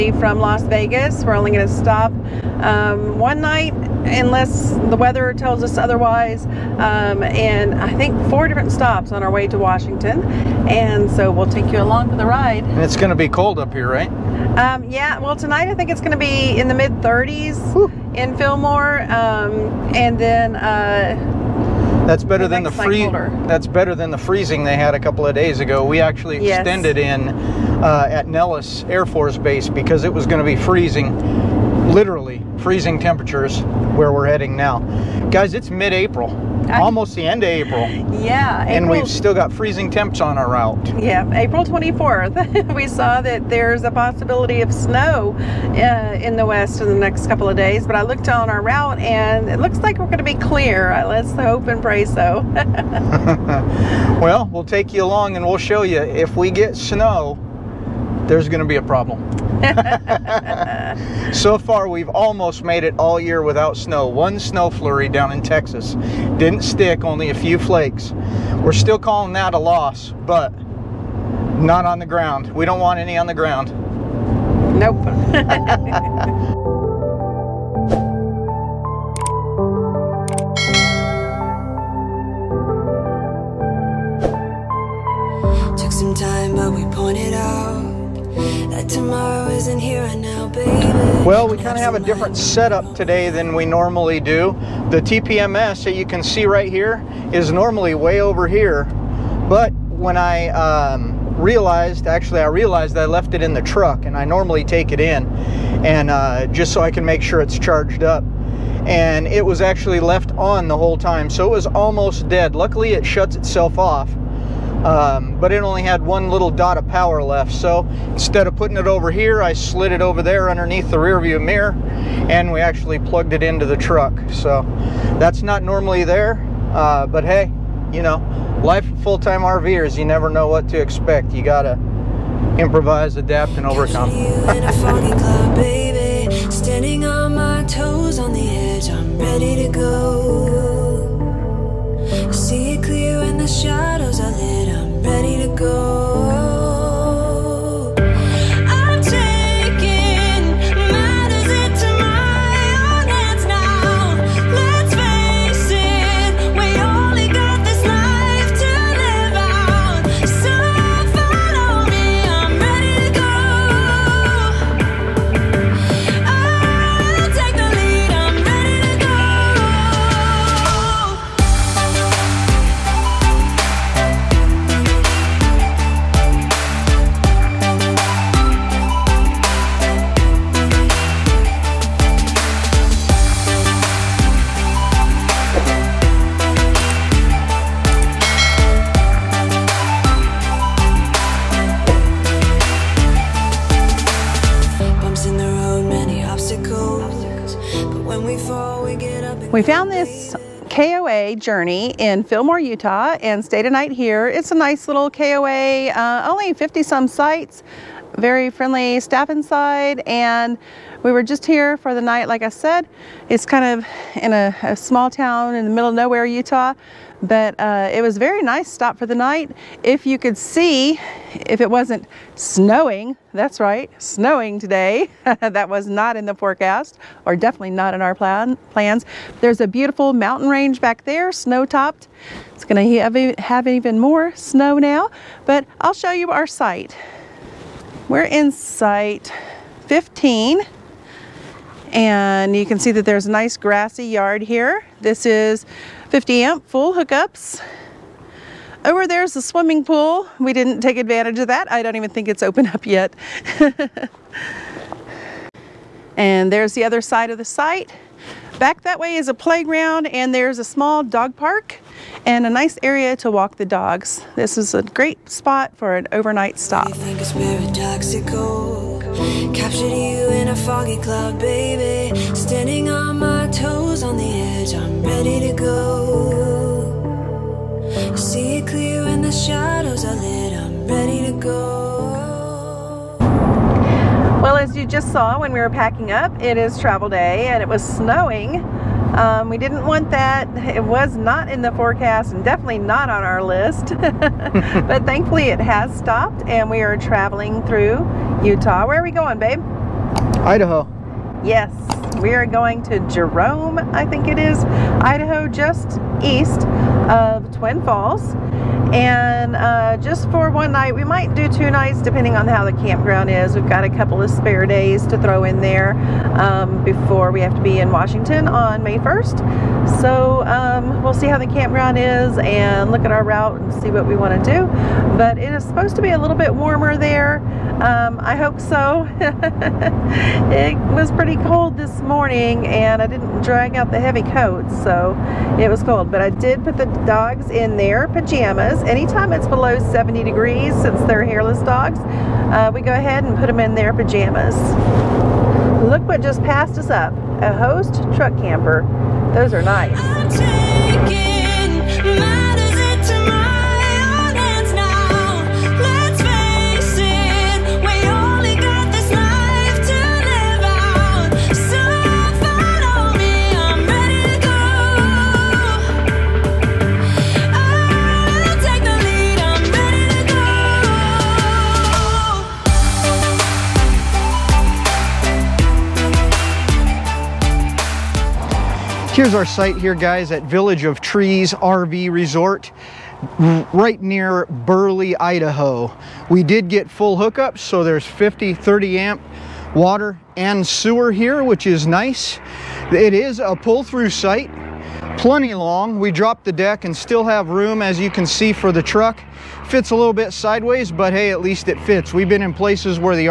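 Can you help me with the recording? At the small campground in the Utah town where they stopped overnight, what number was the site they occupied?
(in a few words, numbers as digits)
15.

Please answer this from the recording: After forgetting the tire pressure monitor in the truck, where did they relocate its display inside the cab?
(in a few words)
underneath the rear view mirror.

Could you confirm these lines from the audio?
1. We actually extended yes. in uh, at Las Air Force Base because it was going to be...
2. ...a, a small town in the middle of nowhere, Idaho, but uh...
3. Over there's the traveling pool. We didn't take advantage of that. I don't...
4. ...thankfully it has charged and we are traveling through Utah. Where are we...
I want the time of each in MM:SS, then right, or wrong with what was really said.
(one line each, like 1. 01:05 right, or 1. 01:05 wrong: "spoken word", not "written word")
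1. 00:25 wrong: "Nellis", not "Las"
2. 03:34 wrong: "Utah", not "Idaho"
3. 04:08 wrong: "swimming", not "traveling"
4. 04:55 wrong: "stopped", not "charged".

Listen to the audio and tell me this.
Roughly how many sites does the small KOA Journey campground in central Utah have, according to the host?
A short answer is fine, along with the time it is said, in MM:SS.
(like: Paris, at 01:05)
50 some, at 03:26.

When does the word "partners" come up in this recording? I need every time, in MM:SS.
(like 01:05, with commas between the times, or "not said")
not said.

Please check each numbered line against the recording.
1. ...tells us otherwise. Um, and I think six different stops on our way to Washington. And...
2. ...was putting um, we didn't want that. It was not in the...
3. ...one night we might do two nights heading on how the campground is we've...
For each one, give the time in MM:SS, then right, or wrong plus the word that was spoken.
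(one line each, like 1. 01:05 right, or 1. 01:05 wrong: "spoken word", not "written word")
1. 00:05 wrong: "four", not "six"
2. 04:47 wrong: "snowing", not "putting"
3. 05:10 wrong: "depending", not "heading".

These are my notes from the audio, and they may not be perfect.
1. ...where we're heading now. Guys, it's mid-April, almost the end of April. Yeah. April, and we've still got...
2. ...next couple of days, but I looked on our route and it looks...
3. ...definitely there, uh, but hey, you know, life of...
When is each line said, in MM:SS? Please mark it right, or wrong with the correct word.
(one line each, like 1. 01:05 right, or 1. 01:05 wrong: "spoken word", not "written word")
1. 00:33 right
2. 00:46 right
3. 02:05 wrong: "normally", not "definitely".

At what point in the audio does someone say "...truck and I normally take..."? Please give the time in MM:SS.
01:43.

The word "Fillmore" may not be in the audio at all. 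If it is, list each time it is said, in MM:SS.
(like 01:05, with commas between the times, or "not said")
00:18, 03:22.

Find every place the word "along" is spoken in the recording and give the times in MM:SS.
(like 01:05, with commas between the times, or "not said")
00:11, 00:55.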